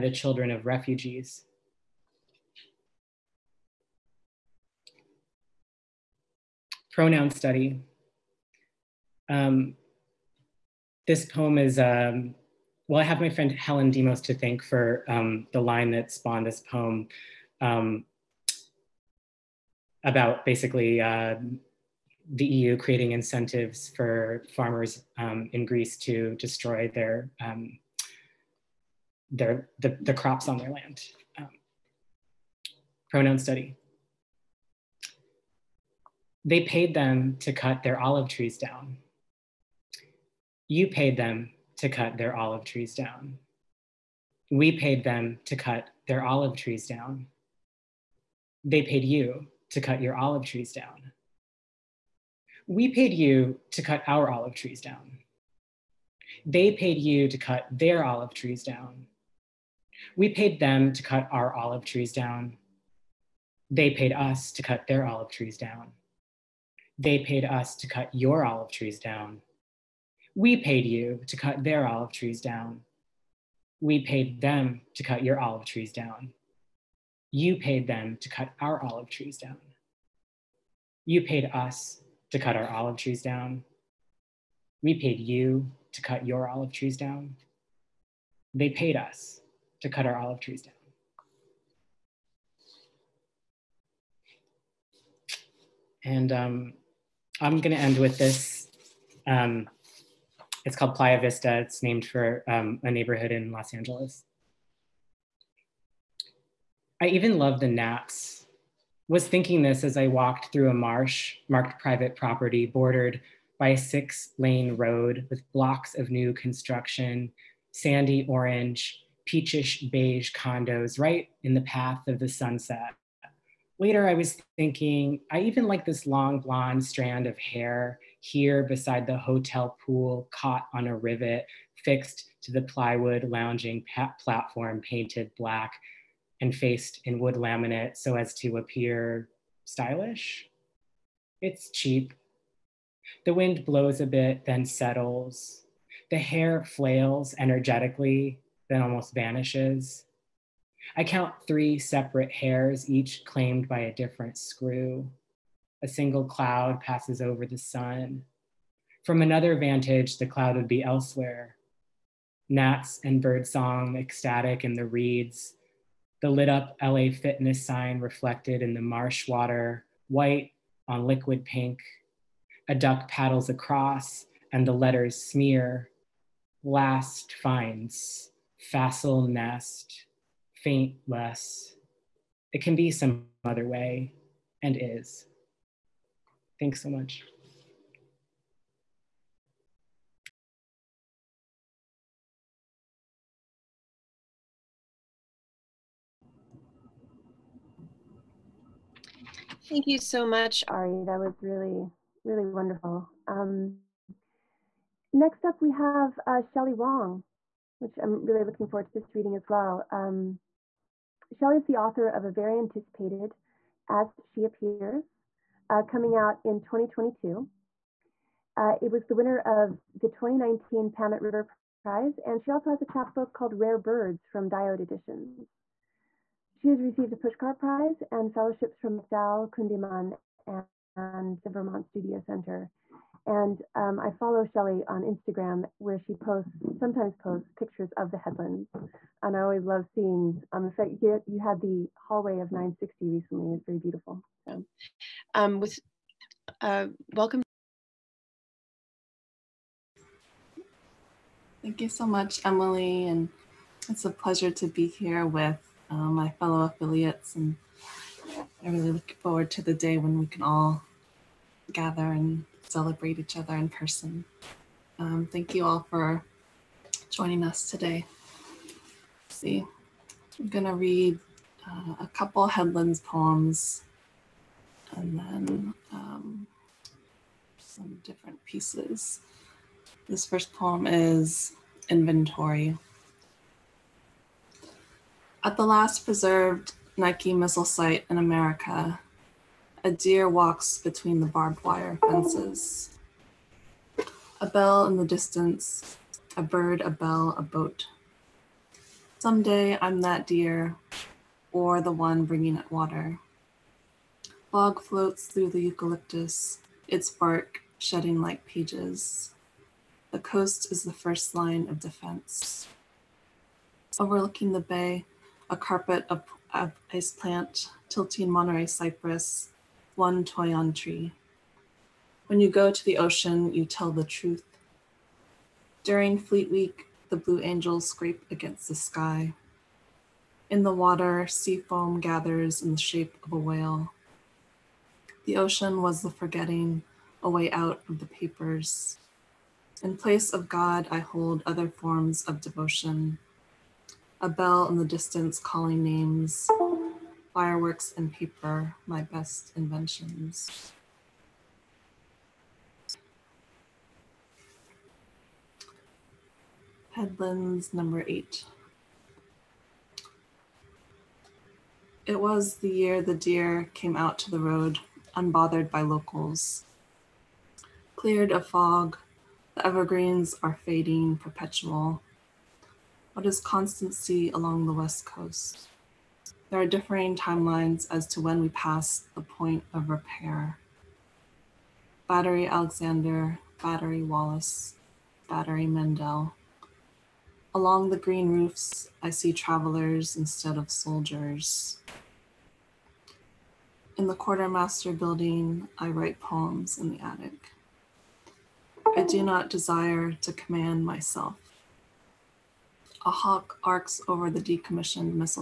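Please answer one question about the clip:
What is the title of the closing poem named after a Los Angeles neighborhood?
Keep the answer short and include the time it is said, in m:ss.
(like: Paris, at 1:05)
Playa Vista, at 1:40.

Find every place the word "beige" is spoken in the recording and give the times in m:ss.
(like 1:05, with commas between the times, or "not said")
1:59.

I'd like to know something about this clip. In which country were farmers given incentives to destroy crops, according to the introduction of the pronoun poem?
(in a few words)
Greece.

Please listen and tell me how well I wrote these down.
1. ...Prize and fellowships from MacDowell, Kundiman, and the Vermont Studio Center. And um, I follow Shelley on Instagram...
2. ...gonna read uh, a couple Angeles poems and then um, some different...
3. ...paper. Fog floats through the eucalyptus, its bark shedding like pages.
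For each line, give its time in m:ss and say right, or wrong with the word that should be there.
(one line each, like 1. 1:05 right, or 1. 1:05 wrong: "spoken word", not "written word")
1. 3:47 right
2. 4:30 wrong: "Headlands", not "Angeles"
3. 5:02 wrong: "water", not "paper".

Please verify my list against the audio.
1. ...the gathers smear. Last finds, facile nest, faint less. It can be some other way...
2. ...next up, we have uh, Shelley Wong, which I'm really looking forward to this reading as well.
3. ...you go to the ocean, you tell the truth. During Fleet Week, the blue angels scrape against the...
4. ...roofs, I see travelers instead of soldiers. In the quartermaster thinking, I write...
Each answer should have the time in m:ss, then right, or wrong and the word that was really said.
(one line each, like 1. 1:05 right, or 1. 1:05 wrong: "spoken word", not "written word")
1. 2:54 wrong: "letters", not "gathers"
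2. 3:25 right
3. 5:22 right
4. 6:28 wrong: "building", not "thinking".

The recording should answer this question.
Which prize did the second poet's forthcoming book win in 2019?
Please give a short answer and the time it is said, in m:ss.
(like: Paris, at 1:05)
Pamet River Prize, at 3:40.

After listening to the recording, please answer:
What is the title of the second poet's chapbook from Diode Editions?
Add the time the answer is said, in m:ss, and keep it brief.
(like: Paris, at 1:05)
Rare Birds, at 3:43.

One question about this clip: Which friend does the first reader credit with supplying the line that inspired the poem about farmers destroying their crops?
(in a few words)
Helen Demos.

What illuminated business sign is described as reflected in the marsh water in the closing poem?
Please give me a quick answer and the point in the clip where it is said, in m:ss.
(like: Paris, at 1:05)
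LA fitness, at 2:46.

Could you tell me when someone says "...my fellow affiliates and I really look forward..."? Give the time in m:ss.
4:15.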